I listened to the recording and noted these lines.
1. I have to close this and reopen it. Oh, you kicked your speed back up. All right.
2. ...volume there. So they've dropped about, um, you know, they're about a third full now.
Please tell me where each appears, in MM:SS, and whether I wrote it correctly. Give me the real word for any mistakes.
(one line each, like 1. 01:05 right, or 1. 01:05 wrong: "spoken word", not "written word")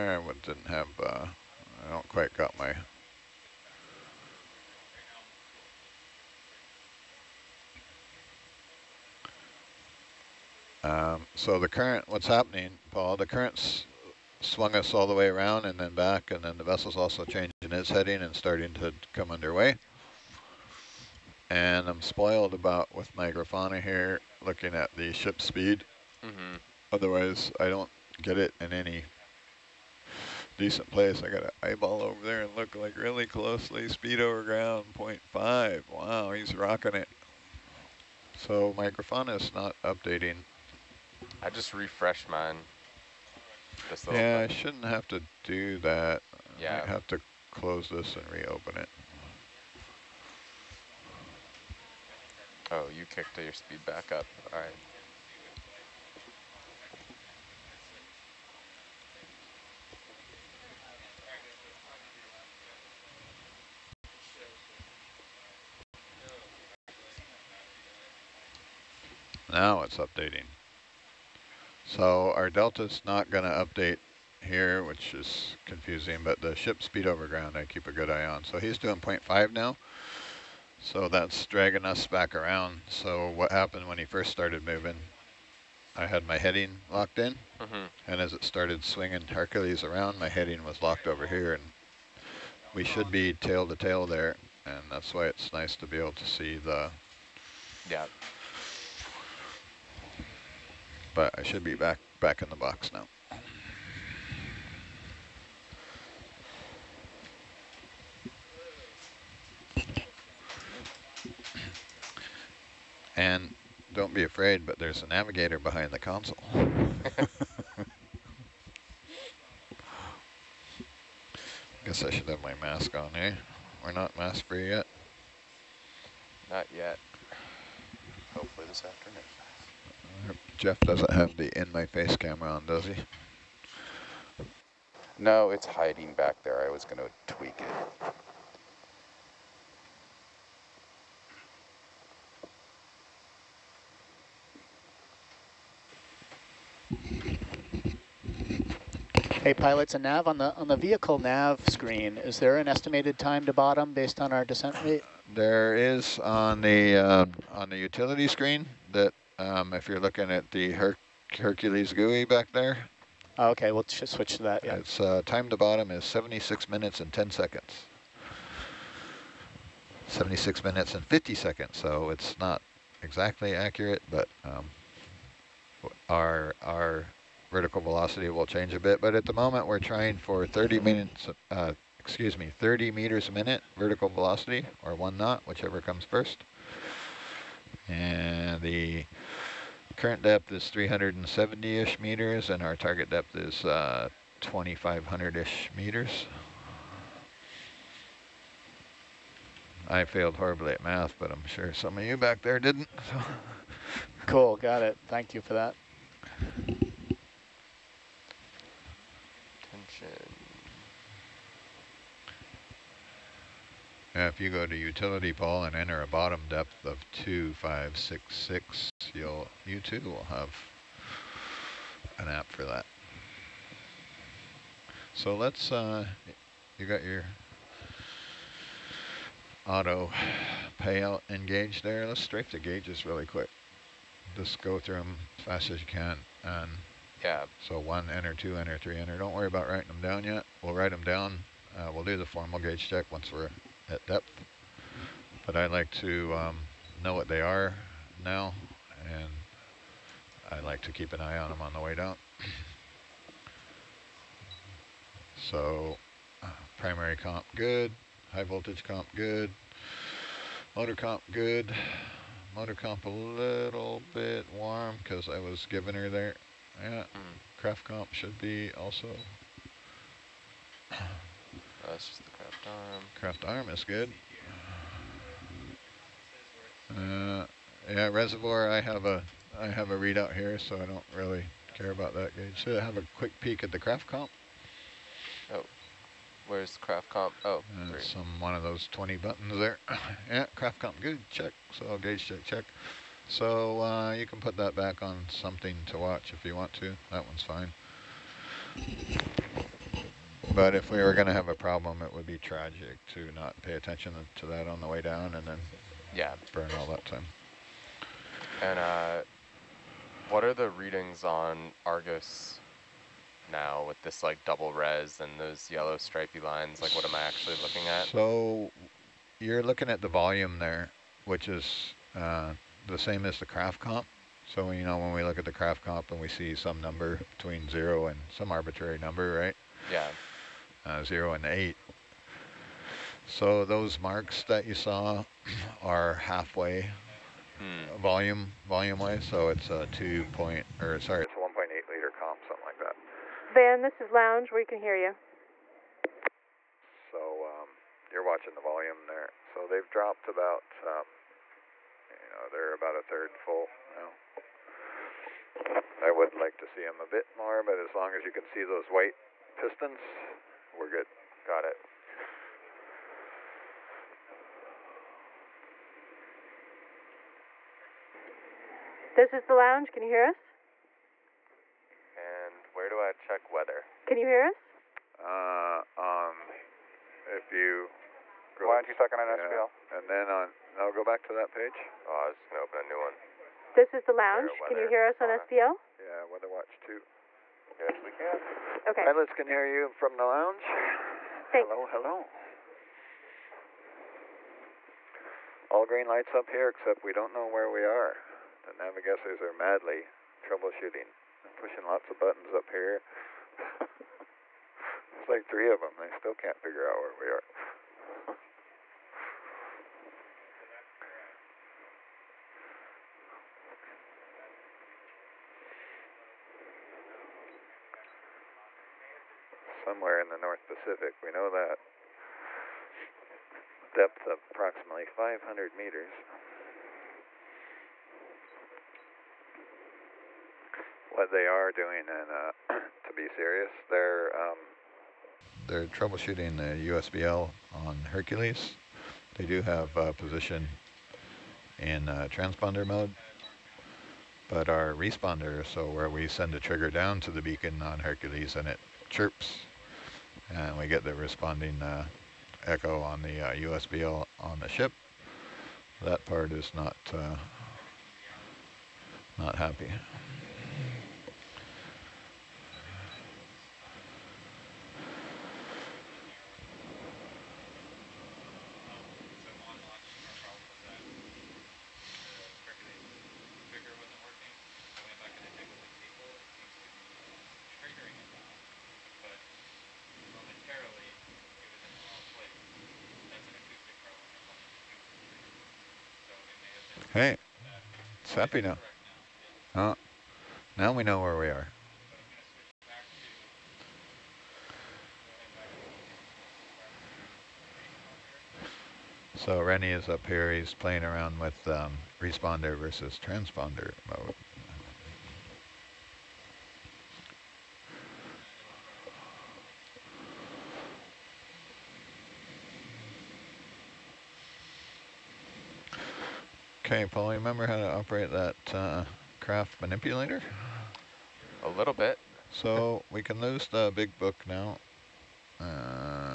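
1. 00:46 right
2. 05:48 right.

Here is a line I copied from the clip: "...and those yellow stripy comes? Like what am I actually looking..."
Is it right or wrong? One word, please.
wrong.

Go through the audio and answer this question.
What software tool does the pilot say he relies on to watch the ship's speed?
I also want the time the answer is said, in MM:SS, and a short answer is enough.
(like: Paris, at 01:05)
Grafana, at 00:23.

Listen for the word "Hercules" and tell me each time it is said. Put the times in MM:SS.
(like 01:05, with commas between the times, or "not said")
01:29, 02:41, 07:18, 07:27.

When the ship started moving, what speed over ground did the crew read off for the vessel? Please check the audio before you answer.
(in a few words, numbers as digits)
0.5.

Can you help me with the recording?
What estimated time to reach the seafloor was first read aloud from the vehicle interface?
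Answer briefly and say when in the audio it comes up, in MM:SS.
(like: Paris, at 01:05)
76 minutes and 10 seconds, at 02:46.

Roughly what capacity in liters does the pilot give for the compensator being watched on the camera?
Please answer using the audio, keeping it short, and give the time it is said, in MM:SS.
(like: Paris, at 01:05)
1.8 liter, at 05:41.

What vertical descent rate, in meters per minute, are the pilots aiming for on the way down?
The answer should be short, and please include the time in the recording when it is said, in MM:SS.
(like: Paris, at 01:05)
30 meters a minute, at 03:02.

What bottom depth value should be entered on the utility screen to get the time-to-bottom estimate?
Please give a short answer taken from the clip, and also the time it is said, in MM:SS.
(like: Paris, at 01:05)
2566, at 03:37.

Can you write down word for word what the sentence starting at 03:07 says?
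And the current depth is 370-ish meters, and our target depth is 2,500-ish uh, meters.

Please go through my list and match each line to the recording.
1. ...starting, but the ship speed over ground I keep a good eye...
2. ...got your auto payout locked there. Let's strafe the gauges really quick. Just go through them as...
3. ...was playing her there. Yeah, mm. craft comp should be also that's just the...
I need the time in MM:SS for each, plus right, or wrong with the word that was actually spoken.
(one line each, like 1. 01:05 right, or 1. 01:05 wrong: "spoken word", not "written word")
1. 01:15 wrong: "confusing", not "starting"
2. 03:46 wrong: "engaged", not "locked"
3. 04:25 wrong: "giving", not "playing".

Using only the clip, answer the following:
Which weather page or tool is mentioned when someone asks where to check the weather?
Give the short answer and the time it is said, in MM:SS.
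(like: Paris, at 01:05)
Weather Watch 2, at 06:26.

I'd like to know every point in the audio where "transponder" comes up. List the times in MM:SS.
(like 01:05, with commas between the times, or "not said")
07:22, 08:23.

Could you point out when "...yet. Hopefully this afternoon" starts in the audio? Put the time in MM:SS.
02:06.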